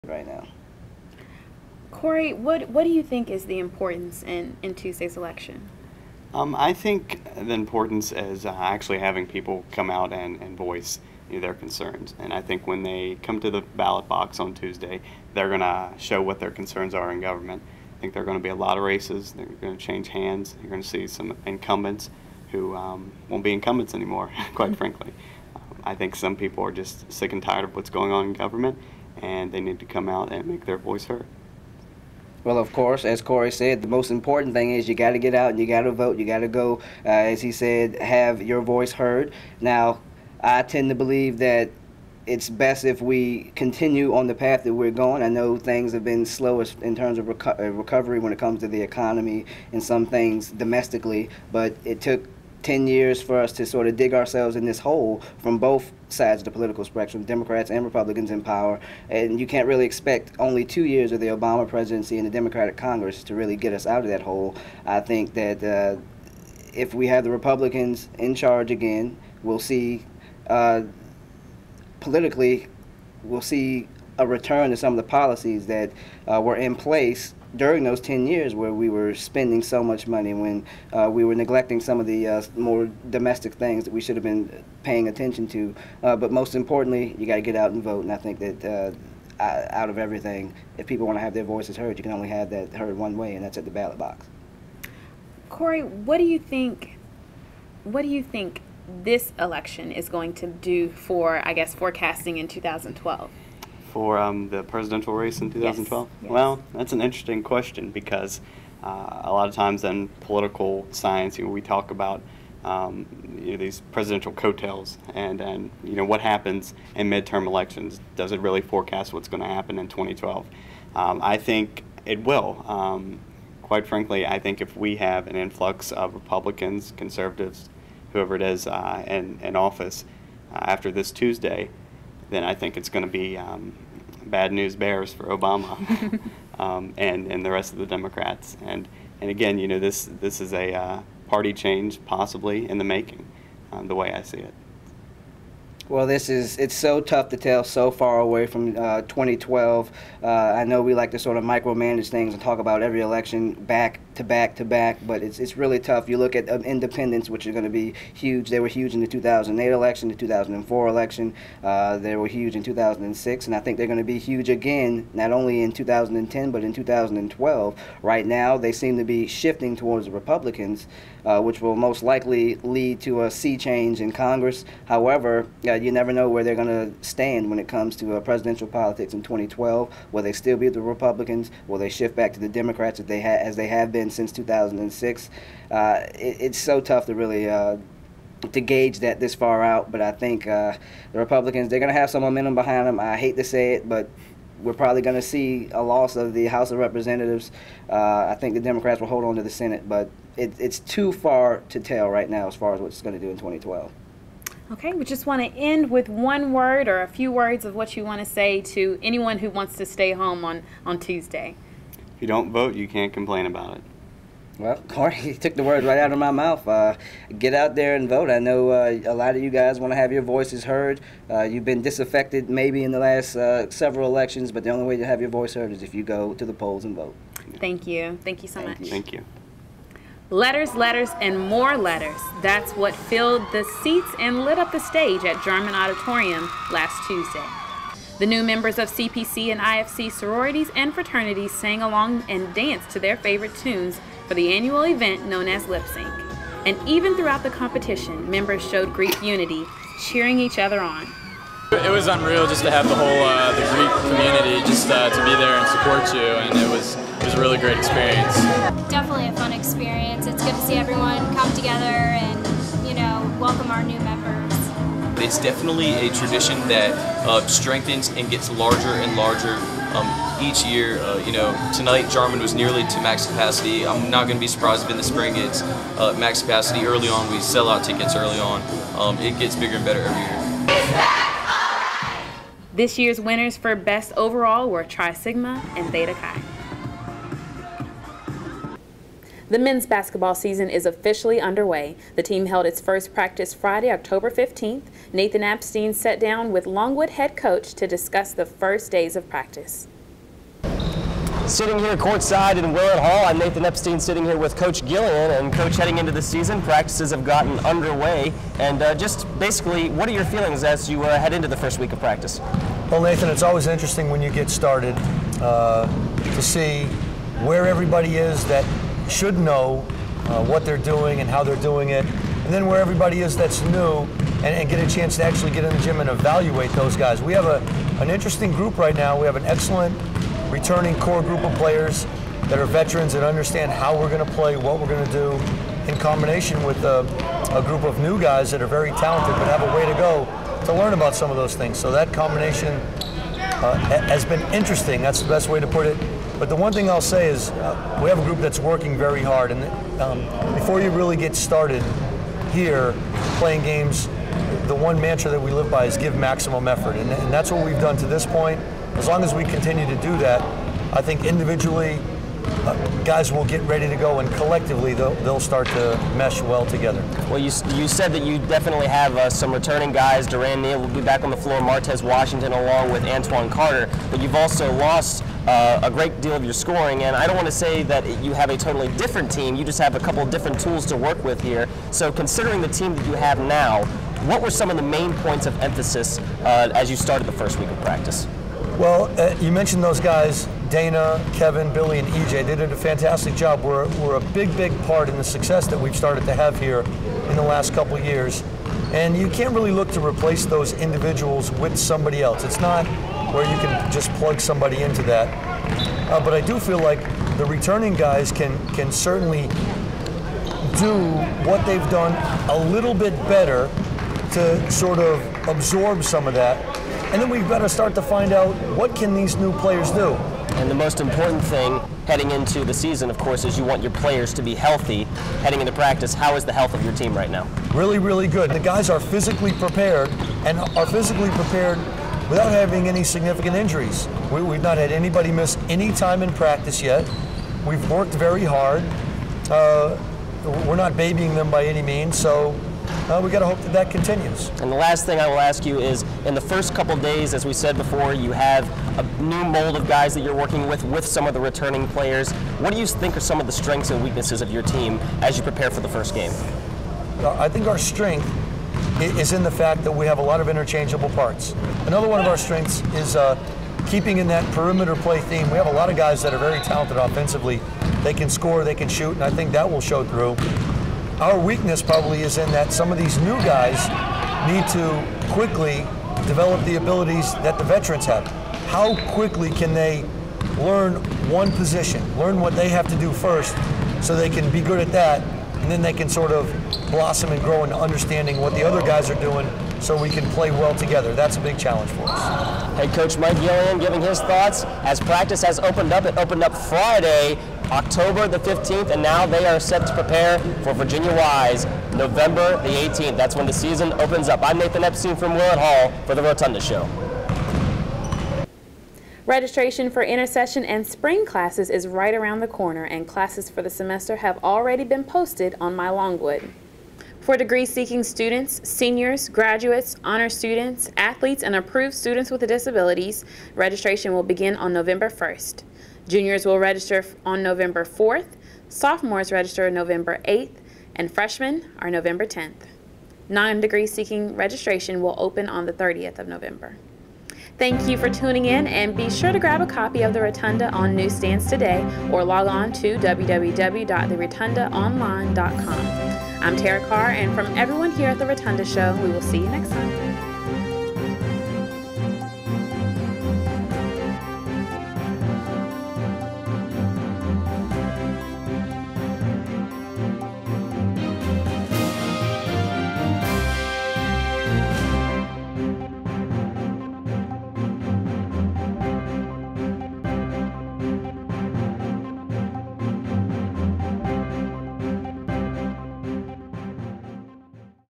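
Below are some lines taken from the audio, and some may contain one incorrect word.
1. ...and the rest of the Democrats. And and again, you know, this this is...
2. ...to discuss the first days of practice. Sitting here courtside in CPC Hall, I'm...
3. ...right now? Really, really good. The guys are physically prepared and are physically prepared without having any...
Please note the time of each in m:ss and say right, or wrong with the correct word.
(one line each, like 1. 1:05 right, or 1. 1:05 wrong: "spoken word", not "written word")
1. 2:17 right
2. 4:57 wrong: "Willett", not "CPC"
3. 7:07 right.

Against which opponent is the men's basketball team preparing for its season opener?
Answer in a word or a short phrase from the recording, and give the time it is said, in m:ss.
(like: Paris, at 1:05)
Virginia Wise, at 8:20.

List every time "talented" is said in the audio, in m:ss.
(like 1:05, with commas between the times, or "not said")
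5:38, 7:46.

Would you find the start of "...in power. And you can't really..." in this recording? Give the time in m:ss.
0:58.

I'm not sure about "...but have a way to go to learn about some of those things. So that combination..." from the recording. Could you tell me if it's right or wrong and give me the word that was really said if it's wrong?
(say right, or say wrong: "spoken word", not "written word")
right.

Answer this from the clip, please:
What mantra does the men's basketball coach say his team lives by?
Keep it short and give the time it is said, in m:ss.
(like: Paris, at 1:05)
give maximum effort, at 5:55.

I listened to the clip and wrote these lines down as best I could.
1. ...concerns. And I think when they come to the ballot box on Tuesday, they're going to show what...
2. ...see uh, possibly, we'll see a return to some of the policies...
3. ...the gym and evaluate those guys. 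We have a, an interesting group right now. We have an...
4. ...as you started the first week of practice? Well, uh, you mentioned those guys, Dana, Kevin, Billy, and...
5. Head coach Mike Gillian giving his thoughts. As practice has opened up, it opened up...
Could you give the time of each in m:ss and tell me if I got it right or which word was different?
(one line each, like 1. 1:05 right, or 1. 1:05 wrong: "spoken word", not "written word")
1. 0:11 right
2. 1:09 wrong: "politically", not "possibly"
3. 5:25 right
4. 6:26 right
5. 8:12 right.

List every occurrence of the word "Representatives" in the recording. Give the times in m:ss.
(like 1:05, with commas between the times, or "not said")
3:16.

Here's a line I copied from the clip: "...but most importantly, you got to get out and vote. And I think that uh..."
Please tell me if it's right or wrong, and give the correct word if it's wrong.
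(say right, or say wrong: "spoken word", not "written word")
right.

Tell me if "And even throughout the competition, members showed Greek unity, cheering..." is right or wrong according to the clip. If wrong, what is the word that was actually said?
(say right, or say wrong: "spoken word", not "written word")
right.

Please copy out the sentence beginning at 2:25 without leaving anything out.
Well, this is it's so tough to tell so far away from uh, 2012.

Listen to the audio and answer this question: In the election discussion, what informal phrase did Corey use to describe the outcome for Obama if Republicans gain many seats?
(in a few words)
bad news bears.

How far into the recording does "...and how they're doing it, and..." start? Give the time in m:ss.
5:21.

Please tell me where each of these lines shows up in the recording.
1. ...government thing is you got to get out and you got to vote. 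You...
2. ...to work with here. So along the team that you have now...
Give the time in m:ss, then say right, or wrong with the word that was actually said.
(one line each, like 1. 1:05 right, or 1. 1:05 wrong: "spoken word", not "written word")
1. 0:34 wrong: "important", not "government"
2. 6:20 wrong: "considering", not "along".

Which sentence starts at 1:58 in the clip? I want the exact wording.
Does it really forecast what's going to happen in 2012?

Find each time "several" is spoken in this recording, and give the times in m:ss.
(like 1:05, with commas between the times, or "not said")
3:43.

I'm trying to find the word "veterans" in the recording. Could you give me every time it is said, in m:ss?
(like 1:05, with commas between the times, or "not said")
5:32, 7:57.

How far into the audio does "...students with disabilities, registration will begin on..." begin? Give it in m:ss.
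8:41.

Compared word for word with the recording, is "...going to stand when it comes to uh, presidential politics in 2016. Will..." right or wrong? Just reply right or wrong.
wrong.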